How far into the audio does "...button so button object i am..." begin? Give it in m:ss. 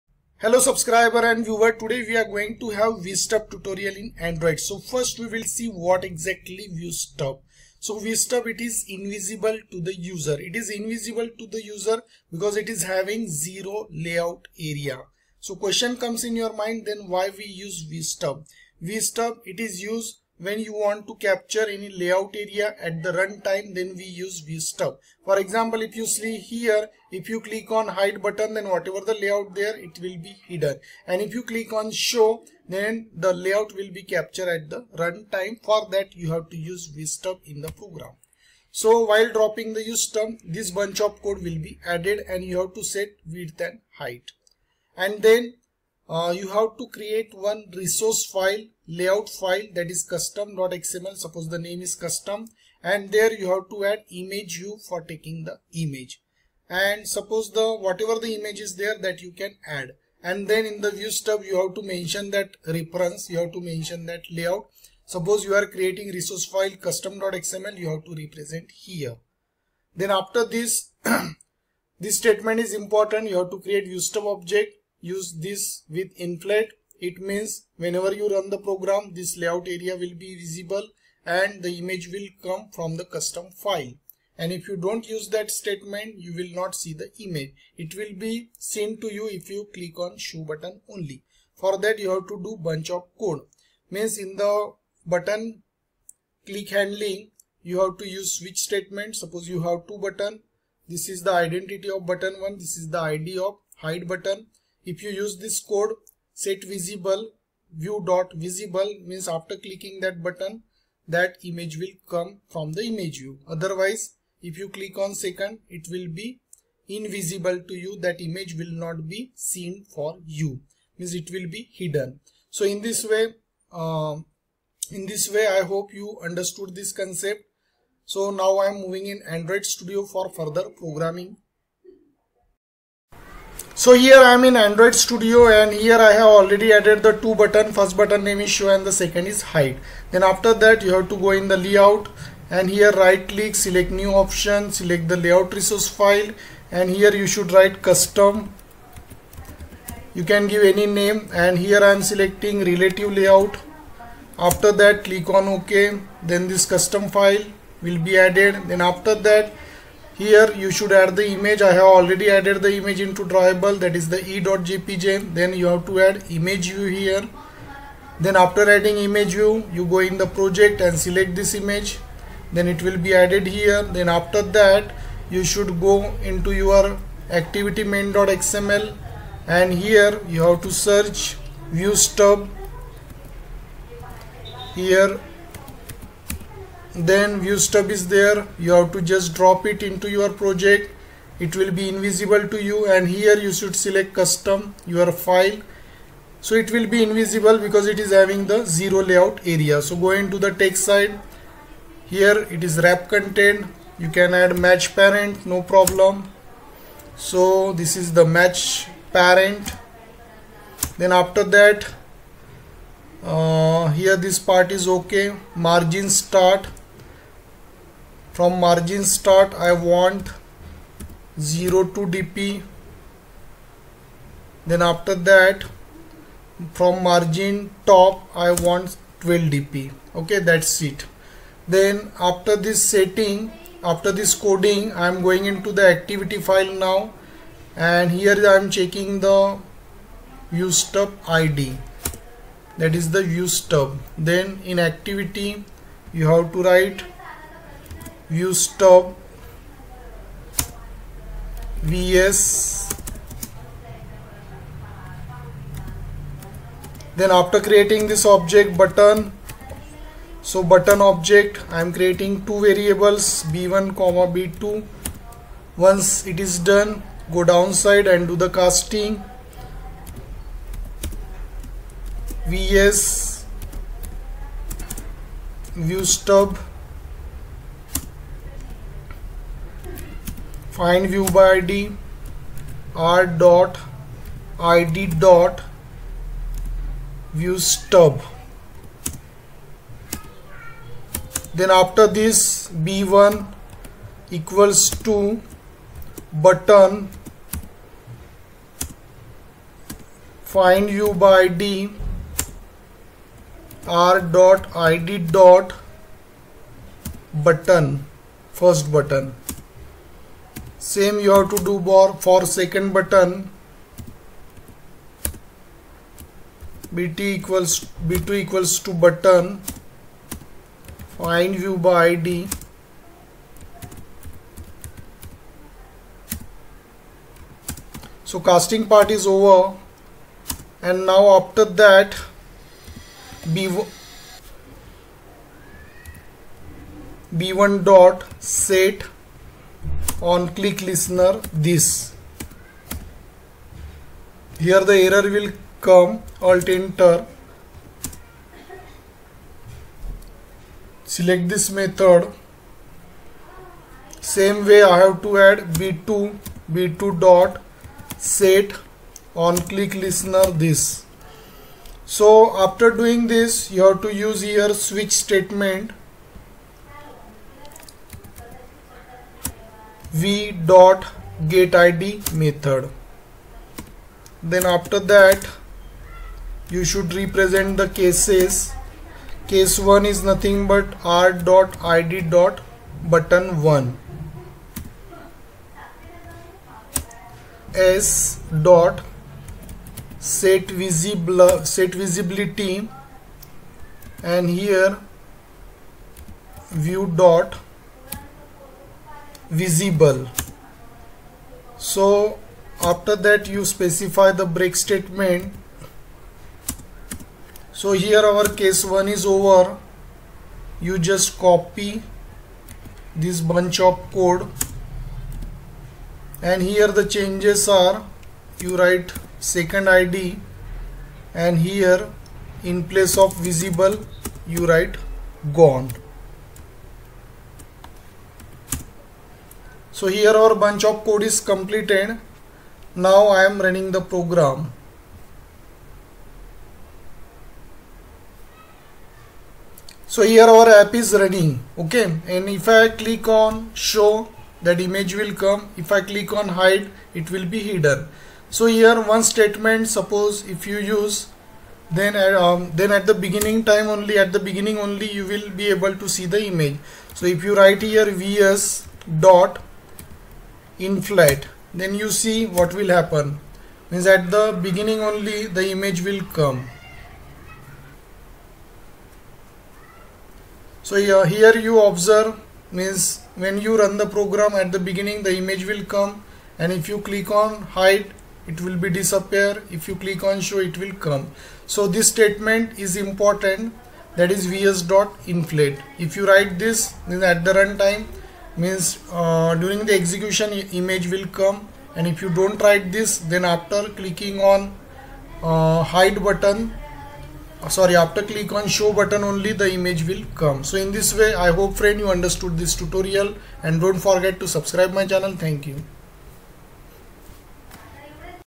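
4:18.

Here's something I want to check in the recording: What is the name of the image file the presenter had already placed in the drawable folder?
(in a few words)
e.jpg.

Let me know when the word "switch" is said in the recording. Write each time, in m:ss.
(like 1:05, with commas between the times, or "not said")
1:38, 6:04.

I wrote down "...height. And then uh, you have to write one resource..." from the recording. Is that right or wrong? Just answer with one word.
wrong.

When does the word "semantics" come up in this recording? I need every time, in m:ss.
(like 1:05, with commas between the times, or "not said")
not said.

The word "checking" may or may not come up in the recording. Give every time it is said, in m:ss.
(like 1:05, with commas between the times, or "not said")
3:58.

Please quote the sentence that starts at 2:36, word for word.
Then this custom file will be added.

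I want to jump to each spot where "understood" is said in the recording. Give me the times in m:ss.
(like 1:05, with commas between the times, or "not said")
2:06, 8:22.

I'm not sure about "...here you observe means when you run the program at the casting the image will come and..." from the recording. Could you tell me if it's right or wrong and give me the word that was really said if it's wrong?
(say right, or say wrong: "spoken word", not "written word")
wrong: "beginning", not "casting".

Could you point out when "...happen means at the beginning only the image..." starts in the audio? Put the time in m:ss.
7:42.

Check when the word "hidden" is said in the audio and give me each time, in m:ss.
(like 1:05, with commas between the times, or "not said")
0:30, 2:01, 7:27.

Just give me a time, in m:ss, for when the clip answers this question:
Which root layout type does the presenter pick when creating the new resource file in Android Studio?
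2:32.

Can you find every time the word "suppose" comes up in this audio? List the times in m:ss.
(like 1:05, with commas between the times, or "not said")
0:51, 0:57, 1:05, 1:39, 7:29.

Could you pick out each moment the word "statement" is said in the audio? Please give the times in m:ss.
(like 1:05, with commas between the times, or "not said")
1:12, 1:25, 1:38, 6:05, 6:44, 7:29, 8:02.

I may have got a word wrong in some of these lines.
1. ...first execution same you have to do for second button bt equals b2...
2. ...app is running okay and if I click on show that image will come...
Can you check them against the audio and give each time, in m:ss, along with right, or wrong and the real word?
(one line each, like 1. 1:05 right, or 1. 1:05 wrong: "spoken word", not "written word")
1. 5:08 wrong: "button", not "execution"
2. 7:20 right.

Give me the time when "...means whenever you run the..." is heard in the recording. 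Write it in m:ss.
1:17.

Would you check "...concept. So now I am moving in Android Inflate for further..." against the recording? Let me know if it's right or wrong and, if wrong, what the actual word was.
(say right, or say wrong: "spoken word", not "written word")
wrong: "Studio", not "Inflate".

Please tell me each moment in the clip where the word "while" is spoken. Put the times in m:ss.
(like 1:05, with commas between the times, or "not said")
0:39.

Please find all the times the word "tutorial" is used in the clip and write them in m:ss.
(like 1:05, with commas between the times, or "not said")
0:03, 8:22.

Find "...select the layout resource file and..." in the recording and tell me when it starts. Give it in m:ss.
2:24.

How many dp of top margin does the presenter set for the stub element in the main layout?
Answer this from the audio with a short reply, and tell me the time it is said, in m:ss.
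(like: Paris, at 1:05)
12 dp, at 3:49.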